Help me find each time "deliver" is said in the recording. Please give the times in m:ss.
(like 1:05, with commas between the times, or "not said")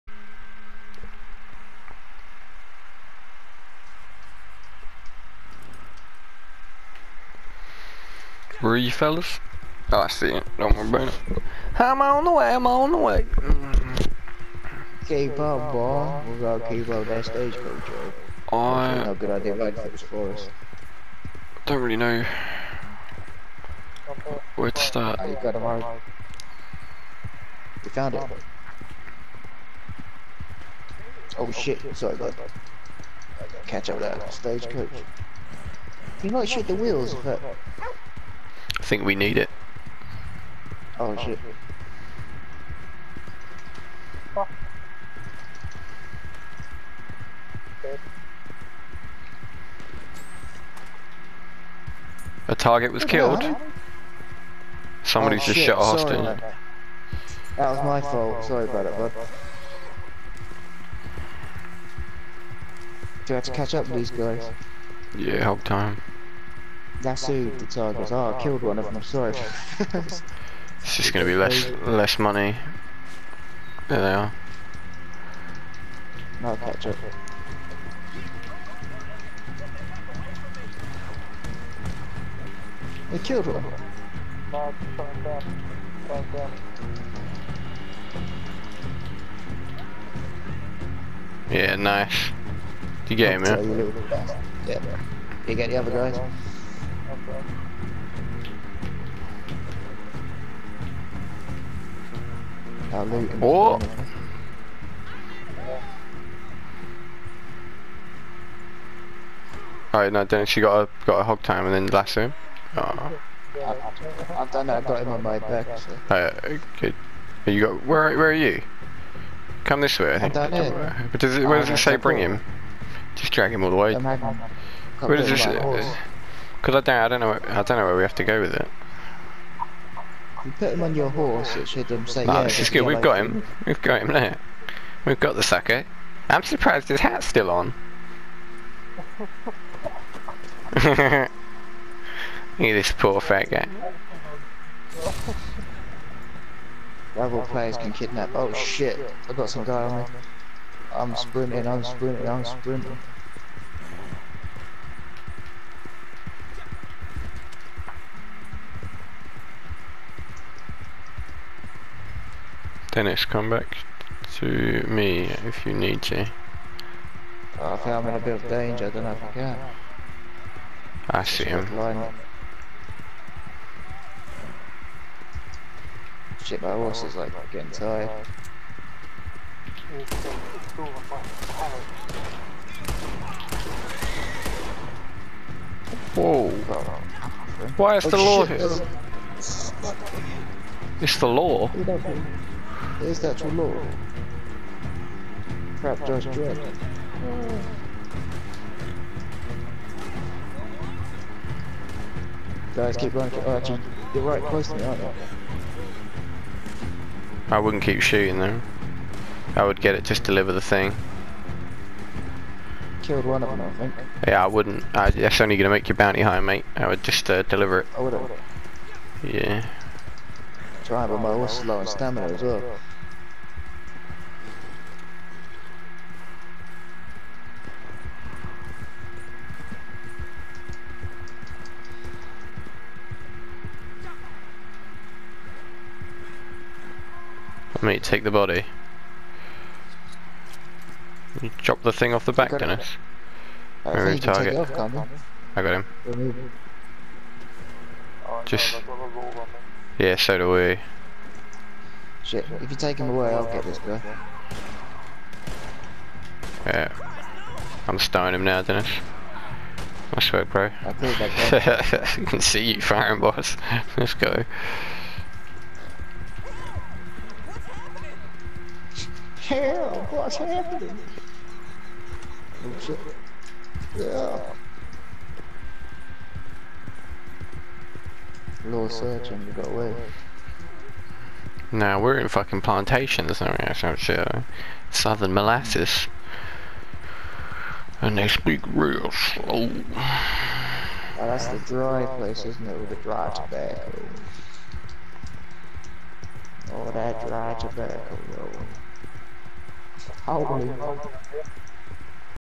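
3:30, 3:37.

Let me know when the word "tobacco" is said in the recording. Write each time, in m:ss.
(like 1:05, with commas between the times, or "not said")
4:53, 4:57.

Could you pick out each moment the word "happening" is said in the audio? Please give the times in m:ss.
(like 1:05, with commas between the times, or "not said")
4:30.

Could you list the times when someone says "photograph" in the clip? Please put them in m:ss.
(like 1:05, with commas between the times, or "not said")
not said.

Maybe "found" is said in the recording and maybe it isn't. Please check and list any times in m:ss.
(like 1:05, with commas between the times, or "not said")
0:27.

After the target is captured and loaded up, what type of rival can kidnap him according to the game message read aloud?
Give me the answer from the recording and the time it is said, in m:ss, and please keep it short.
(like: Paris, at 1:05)
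Rival players, at 2:27.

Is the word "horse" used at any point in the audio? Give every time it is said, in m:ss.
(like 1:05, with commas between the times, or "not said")
2:11, 2:56, 3:41.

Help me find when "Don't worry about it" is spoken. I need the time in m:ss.
0:10.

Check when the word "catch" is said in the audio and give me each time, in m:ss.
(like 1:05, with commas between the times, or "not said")
0:33, 1:03, 1:16.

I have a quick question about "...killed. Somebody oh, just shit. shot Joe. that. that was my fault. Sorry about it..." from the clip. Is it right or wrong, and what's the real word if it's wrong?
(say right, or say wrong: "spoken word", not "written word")
wrong: "Austin", not "Joe".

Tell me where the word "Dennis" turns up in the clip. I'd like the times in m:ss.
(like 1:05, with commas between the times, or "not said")
2:42, 4:02, 4:18.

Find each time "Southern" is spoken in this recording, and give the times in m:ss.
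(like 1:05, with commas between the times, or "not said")
4:44.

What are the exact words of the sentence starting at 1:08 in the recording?
Oh, I killed one of them, I'm sorry.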